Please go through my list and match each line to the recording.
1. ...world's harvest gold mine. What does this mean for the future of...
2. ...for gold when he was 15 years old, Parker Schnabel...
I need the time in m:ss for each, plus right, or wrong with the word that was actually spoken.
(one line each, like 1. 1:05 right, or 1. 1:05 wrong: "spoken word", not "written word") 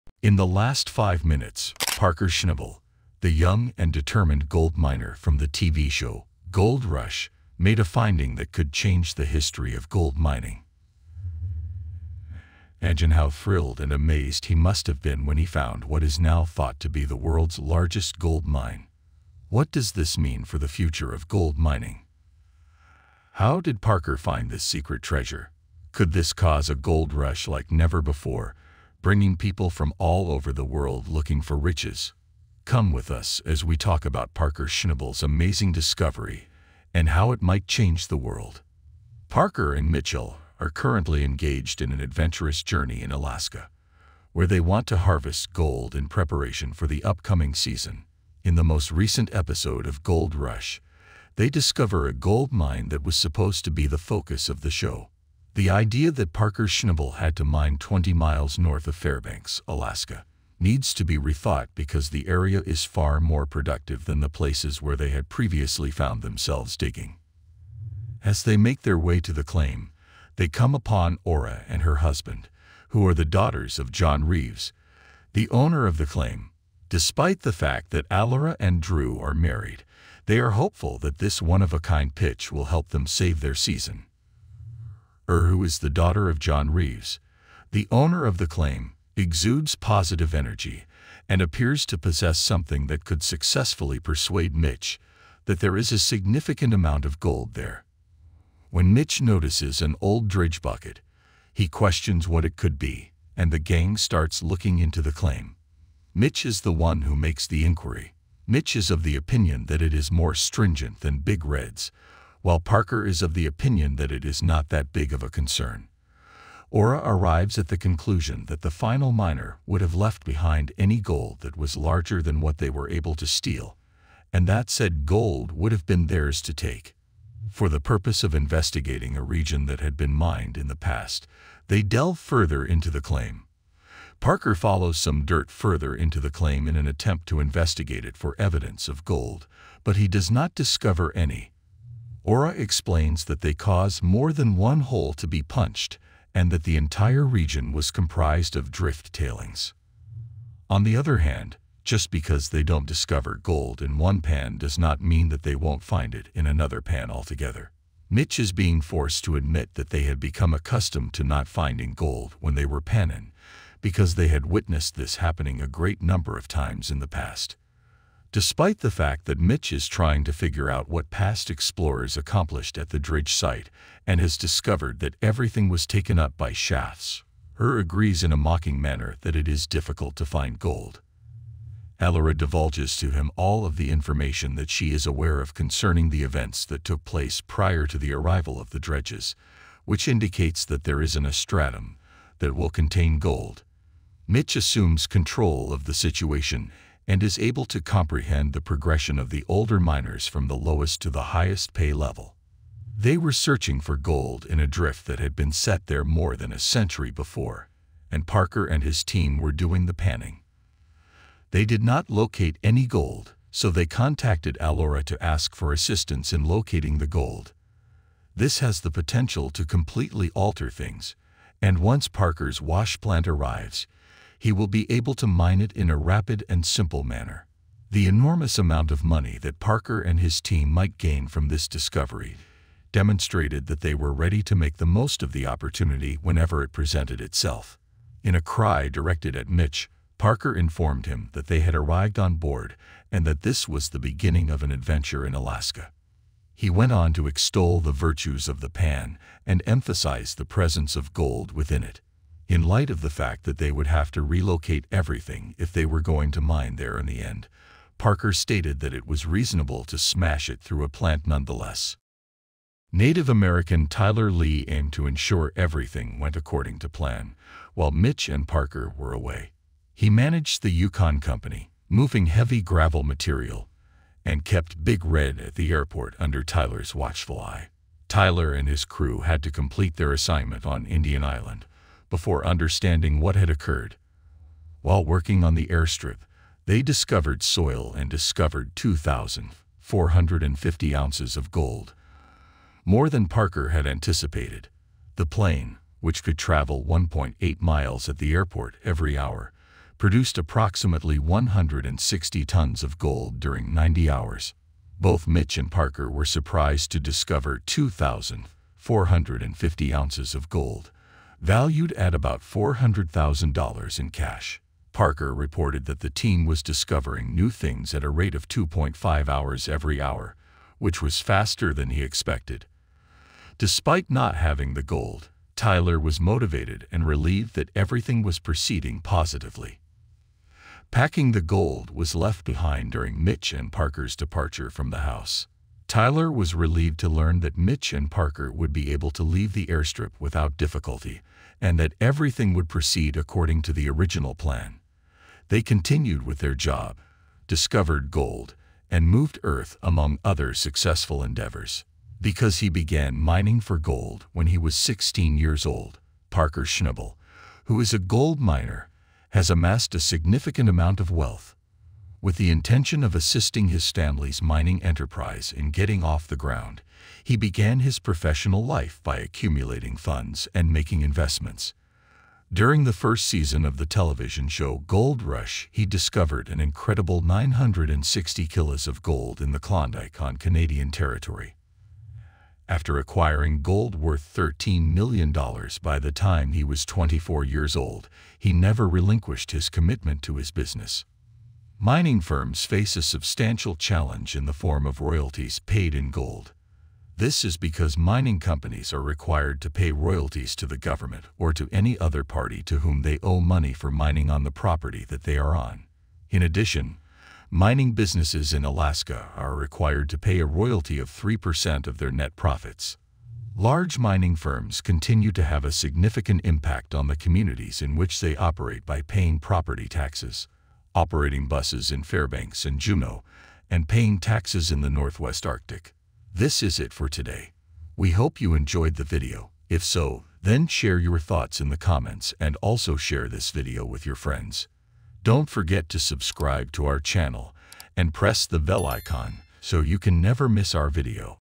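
1. 0:17 wrong: "largest", not "harvest"
2. 5:53 wrong: "16", not "15".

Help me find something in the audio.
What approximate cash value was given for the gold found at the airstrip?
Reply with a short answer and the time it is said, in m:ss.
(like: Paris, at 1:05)
$400,000, at 5:12.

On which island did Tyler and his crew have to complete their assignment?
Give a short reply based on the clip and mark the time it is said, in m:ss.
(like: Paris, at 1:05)
Indian Island, at 4:40.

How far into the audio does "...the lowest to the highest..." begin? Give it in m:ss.
3:20.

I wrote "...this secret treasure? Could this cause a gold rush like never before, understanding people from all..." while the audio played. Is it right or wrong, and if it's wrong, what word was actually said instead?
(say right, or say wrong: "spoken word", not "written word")
wrong: "bringing", not "understanding".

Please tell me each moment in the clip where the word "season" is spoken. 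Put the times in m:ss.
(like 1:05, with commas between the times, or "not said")
0:47, 1:23, 6:13.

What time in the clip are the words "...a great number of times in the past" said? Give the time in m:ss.
2:45.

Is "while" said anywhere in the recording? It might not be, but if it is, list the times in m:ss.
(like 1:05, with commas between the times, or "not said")
1:52, 4:27, 4:44.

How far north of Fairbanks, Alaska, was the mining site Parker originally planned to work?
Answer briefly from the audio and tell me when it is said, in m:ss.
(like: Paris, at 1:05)
20 miles, at 0:57.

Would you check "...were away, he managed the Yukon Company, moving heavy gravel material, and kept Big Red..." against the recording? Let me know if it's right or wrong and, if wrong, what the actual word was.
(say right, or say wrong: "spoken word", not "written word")
right.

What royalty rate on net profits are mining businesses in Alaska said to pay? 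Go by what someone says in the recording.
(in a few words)
3%.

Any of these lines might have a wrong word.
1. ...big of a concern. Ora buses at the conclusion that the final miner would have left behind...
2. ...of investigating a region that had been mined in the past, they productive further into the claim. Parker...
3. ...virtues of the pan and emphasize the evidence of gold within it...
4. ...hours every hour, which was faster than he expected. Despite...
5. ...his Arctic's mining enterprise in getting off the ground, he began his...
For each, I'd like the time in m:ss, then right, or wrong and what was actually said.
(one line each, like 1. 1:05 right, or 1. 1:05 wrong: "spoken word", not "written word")
1. 1:54 wrong: "arrives", not "buses"
2. 2:08 wrong: "delve", not "productive"
3. 4:07 wrong: "presence", not "evidence"
4. 5:19 right
5. 6:03 wrong: "Stanley", not "Arctic".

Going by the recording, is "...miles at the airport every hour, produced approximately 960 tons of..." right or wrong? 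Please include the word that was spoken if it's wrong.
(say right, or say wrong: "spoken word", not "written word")
wrong: "160", not "960".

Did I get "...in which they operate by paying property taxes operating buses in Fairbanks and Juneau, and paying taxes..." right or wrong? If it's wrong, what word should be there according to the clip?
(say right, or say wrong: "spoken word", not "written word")
right.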